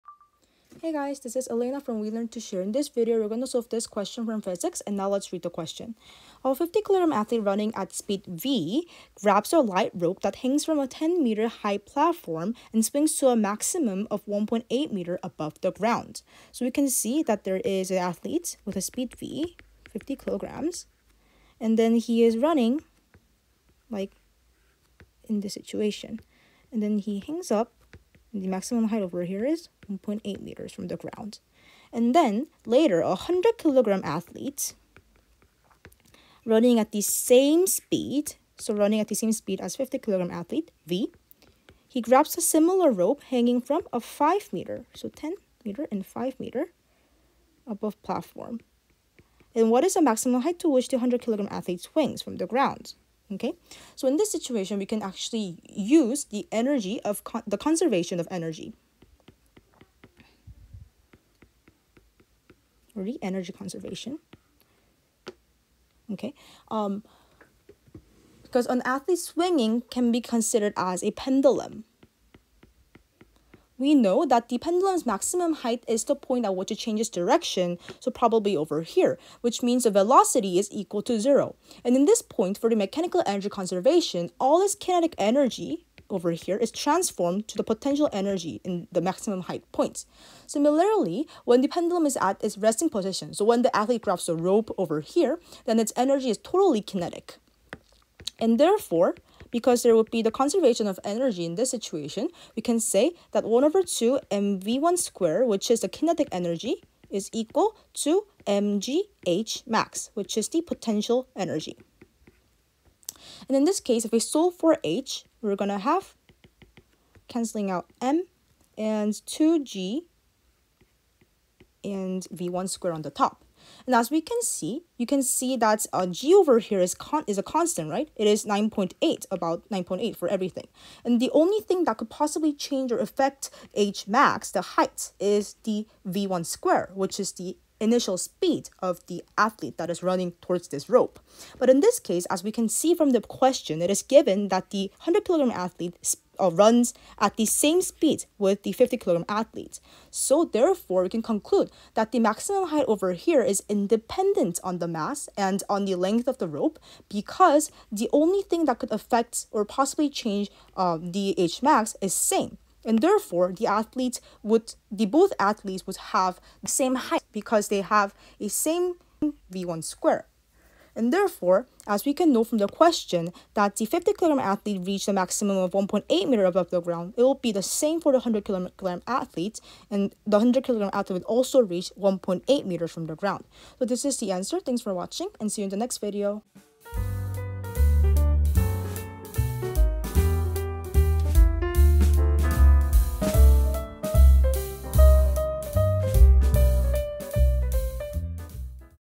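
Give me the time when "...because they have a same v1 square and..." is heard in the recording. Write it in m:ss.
2:47.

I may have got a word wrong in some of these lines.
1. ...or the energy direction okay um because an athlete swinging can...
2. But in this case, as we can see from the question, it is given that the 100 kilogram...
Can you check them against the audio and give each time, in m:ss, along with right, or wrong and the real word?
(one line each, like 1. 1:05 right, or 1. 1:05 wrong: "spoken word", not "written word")
1. 1:02 wrong: "conservation", not "direction"
2. 2:21 right.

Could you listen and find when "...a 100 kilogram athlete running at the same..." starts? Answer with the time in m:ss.
0:33.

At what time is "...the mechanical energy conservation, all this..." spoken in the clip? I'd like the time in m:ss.
1:22.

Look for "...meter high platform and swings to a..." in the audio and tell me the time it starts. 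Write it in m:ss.
0:11.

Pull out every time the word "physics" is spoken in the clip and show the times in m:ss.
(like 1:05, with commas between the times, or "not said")
0:04.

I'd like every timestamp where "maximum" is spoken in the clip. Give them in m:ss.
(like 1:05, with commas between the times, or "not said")
0:13, 0:28, 0:50, 1:15, 1:29, 2:32, 2:55.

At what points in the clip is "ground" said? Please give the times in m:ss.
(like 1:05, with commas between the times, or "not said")
0:15, 0:30, 0:52, 2:56, 3:03.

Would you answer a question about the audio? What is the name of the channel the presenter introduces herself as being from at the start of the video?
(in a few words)
We Learn to Share.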